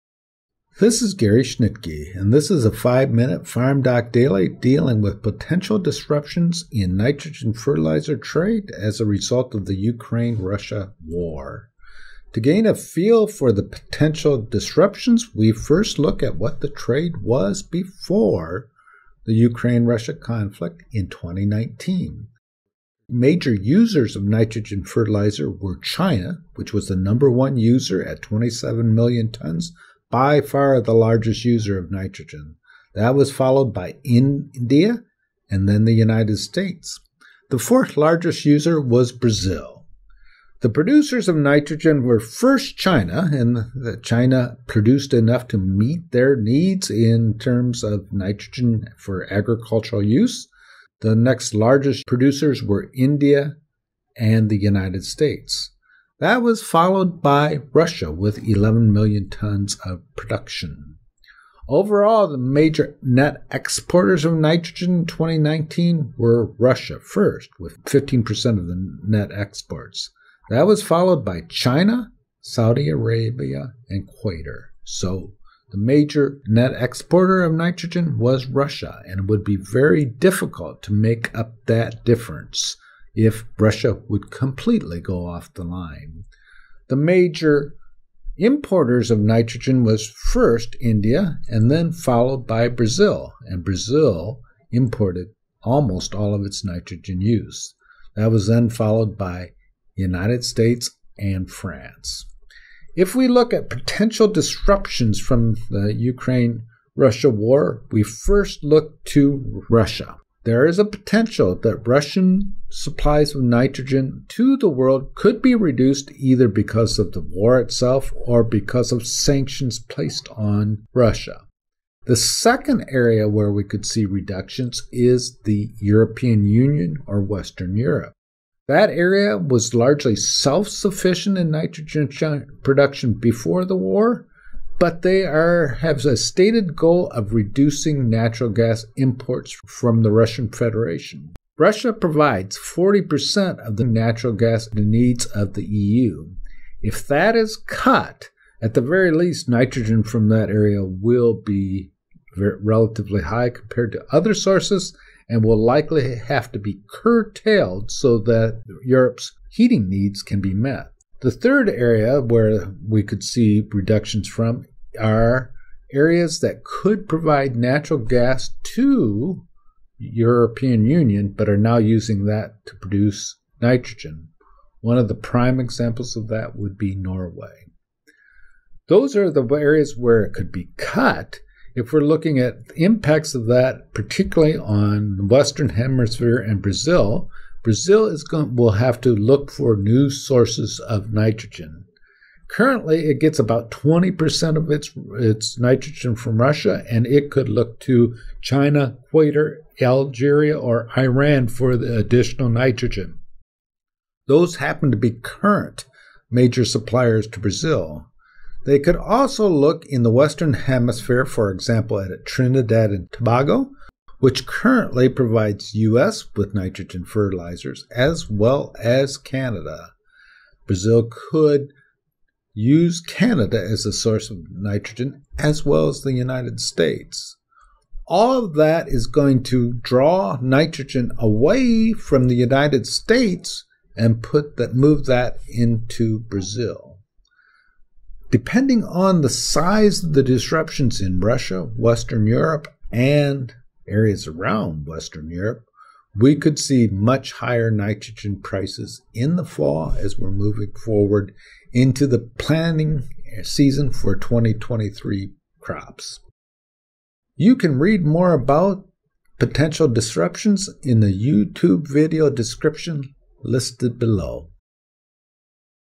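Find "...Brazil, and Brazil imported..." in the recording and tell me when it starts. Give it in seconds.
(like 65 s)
92 s.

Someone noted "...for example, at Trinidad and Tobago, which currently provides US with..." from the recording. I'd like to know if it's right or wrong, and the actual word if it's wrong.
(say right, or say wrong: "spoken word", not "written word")
right.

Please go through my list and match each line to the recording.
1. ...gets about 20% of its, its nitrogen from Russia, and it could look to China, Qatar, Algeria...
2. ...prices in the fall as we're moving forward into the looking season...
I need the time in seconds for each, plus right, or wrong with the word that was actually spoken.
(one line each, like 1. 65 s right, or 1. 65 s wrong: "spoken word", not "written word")
1. 193 s right
2. 248 s wrong: "planning", not "looking".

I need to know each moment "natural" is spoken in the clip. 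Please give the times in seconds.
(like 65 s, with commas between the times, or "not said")
138 s, 143 s, 167 s.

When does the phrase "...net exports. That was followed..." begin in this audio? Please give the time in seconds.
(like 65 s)
69 s.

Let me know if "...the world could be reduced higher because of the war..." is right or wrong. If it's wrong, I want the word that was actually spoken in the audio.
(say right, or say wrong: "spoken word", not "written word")
wrong: "either", not "higher".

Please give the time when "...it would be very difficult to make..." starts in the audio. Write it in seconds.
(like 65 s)
79 s.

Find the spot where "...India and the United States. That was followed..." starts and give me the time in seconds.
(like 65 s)
52 s.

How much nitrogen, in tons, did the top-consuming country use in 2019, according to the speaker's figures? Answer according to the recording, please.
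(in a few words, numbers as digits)
27 million tons.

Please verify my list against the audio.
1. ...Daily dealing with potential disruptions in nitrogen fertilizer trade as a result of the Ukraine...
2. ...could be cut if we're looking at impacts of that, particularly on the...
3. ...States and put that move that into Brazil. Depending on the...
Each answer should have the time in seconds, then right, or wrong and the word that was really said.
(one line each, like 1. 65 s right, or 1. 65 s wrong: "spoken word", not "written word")
1. 4 s right
2. 180 s right
3. 232 s right.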